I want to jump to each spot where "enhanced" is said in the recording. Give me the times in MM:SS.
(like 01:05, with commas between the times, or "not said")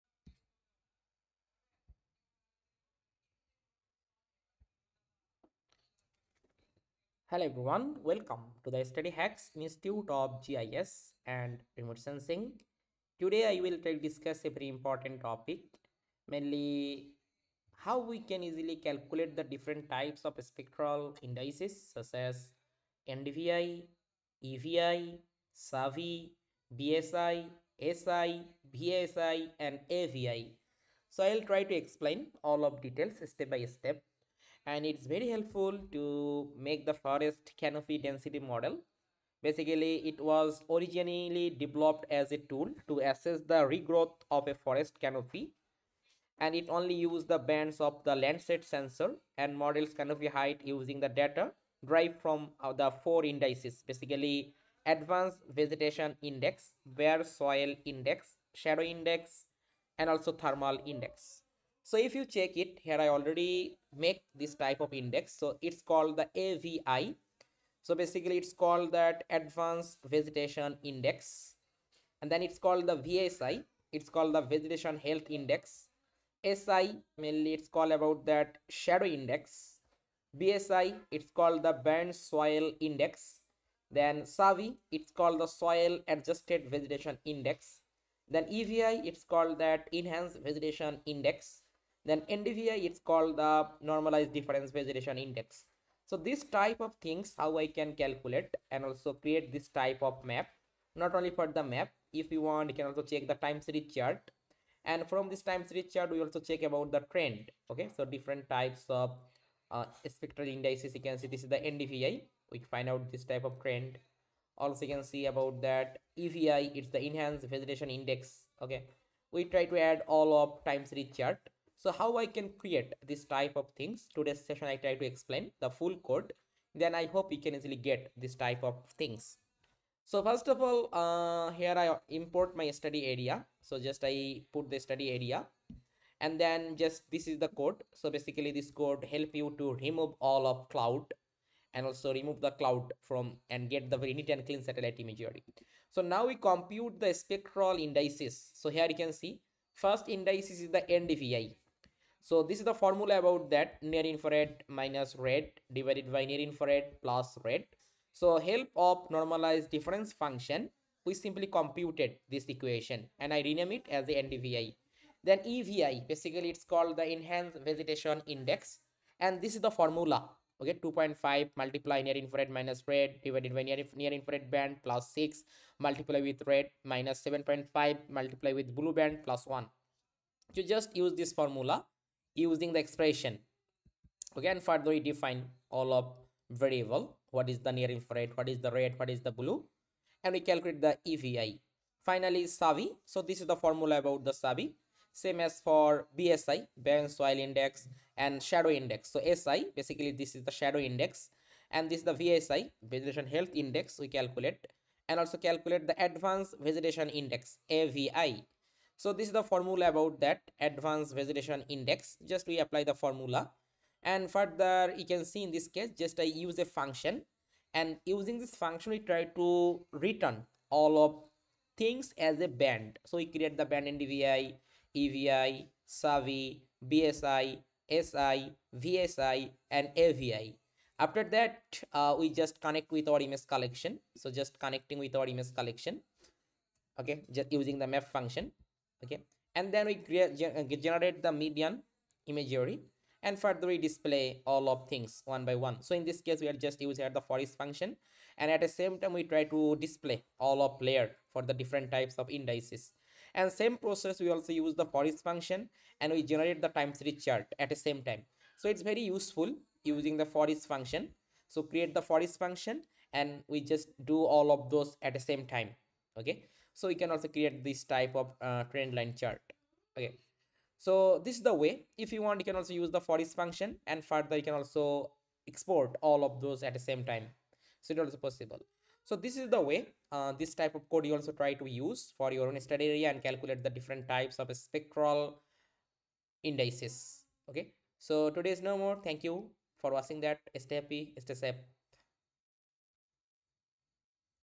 01:29, 01:57, 02:47.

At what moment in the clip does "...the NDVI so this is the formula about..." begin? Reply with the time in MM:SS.
02:30.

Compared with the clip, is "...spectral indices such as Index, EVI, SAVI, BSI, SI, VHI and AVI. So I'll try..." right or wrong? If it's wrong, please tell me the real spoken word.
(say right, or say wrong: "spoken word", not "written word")
wrong: "NDVI", not "Index".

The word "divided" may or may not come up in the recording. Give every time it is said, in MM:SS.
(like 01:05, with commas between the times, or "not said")
02:35, 02:53.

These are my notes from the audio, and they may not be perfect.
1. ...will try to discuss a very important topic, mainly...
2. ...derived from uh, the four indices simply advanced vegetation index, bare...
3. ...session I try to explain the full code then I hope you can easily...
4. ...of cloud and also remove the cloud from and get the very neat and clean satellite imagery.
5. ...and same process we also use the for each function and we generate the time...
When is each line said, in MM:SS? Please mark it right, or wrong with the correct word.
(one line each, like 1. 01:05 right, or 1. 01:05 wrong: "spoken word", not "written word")
1. 00:13 right
2. 00:51 wrong: "basically", not "simply"
3. 02:04 right
4. 02:20 right
5. 04:13 right.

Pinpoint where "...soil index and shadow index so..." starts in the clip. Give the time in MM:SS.
03:17.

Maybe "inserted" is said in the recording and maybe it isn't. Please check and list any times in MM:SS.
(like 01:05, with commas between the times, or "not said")
not said.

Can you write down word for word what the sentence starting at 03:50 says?
After that, uh, we just connect with our image collection.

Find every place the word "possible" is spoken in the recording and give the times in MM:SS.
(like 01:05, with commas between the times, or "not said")
04:38.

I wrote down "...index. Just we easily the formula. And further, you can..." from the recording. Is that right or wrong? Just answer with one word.
wrong.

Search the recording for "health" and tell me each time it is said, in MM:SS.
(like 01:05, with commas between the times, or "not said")
01:15, 03:23.